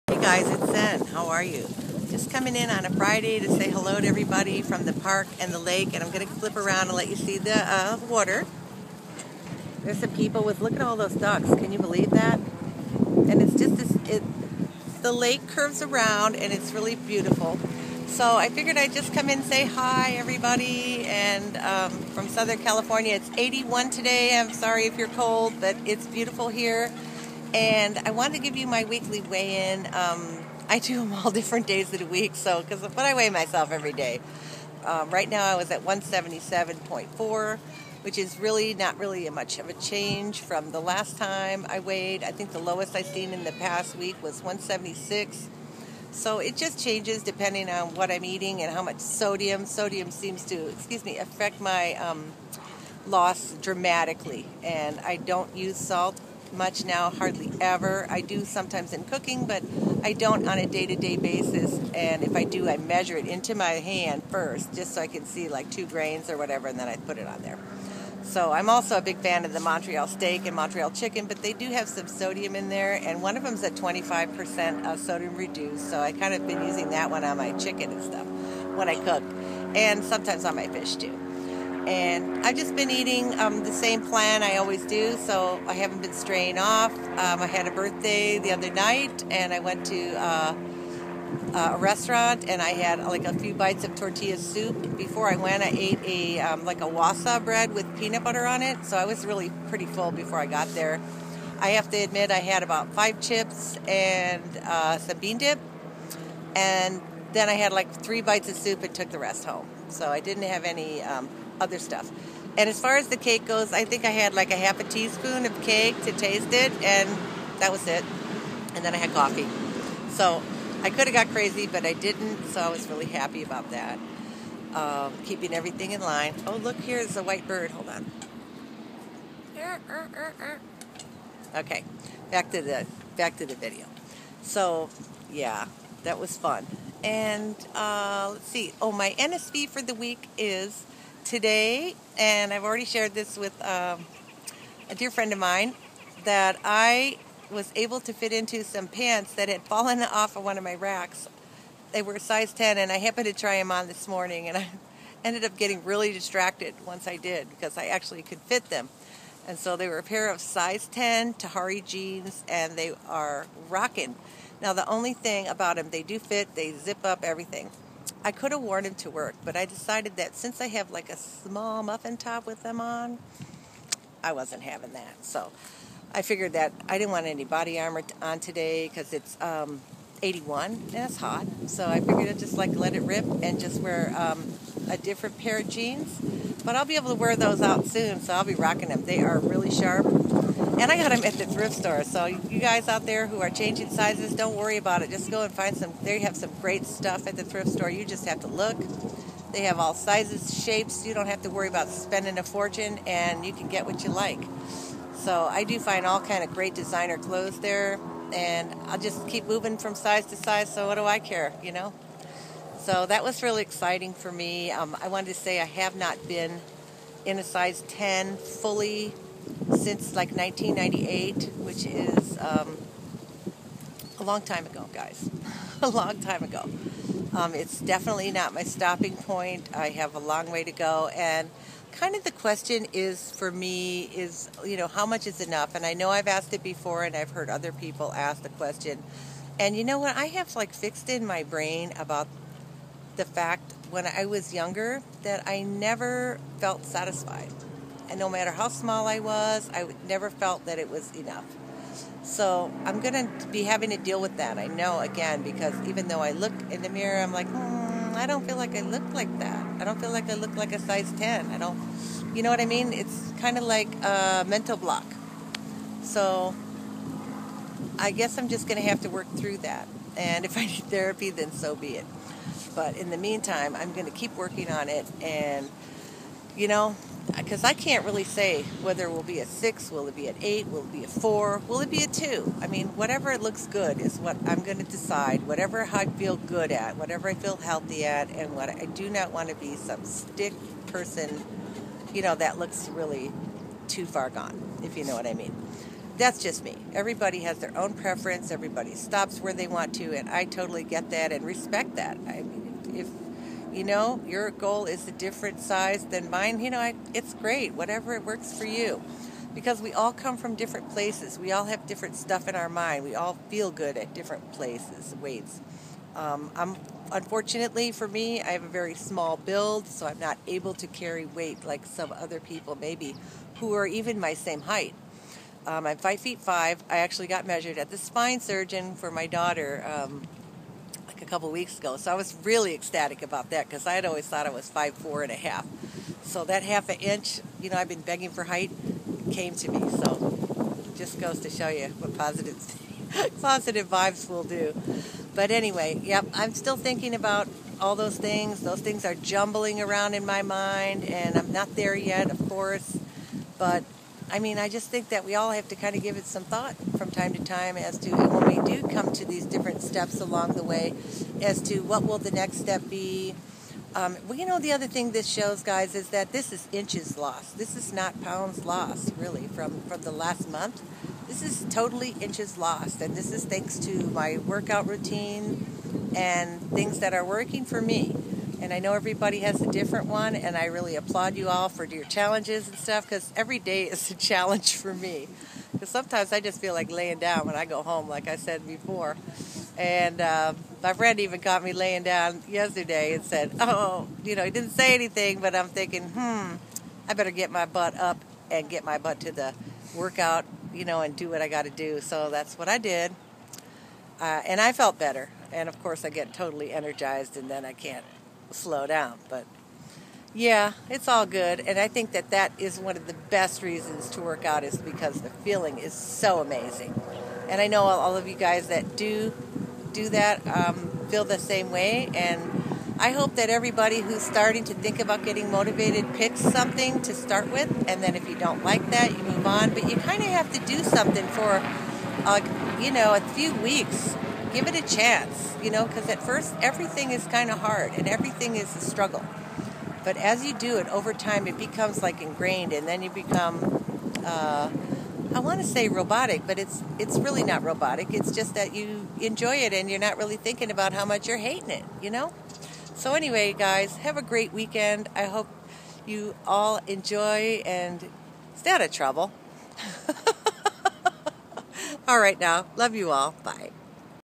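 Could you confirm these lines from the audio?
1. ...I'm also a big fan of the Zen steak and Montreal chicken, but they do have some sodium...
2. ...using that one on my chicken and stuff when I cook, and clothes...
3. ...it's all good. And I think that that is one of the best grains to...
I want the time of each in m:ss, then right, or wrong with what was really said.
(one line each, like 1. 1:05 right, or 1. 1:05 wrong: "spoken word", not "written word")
1. 1:08 wrong: "Montreal", not "Zen"
2. 1:16 wrong: "sometimes", not "clothes"
3. 6:50 wrong: "reasons", not "grains".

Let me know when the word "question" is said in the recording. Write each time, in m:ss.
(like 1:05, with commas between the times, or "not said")
3:52, 3:58.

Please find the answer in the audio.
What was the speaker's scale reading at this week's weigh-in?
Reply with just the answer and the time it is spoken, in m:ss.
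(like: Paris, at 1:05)
177.4, at 0:35.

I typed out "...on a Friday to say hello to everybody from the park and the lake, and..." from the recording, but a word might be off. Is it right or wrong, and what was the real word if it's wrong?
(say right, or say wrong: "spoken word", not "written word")
right.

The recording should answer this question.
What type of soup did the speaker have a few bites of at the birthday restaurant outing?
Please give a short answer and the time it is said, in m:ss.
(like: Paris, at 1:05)
tortilla soup, at 1:33.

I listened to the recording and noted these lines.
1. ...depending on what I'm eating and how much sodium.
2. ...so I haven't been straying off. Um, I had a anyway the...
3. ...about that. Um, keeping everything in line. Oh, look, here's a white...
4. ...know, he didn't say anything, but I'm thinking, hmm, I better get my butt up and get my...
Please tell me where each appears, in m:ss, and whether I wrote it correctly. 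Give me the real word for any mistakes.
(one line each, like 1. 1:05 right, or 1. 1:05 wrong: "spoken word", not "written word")
1. 0:47 right
2. 1:25 wrong: "birthday", not "anyway"
3. 2:03 right
4. 6:34 right.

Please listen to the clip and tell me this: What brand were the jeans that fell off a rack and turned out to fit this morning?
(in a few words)
Tahari.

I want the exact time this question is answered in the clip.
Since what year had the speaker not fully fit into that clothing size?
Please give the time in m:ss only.
3:40.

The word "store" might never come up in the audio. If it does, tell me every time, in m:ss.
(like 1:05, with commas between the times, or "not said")
3:11, 3:17.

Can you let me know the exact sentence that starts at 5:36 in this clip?
So that half an inch, you know, I've been begging for height, came to me.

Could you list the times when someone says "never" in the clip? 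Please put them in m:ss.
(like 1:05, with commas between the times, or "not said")
4:05, 4:10.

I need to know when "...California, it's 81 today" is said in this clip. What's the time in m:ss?
0:22.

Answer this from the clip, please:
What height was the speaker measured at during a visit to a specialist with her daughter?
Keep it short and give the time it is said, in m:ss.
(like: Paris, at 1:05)
five feet five, at 5:25.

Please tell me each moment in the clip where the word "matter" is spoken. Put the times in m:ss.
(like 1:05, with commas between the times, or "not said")
4:08.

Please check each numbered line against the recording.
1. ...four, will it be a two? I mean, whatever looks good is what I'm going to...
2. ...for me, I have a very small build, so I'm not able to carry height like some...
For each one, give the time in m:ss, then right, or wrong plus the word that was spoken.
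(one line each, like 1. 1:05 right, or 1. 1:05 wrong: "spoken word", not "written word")
1. 4:41 right
2. 5:17 wrong: "weight", not "height".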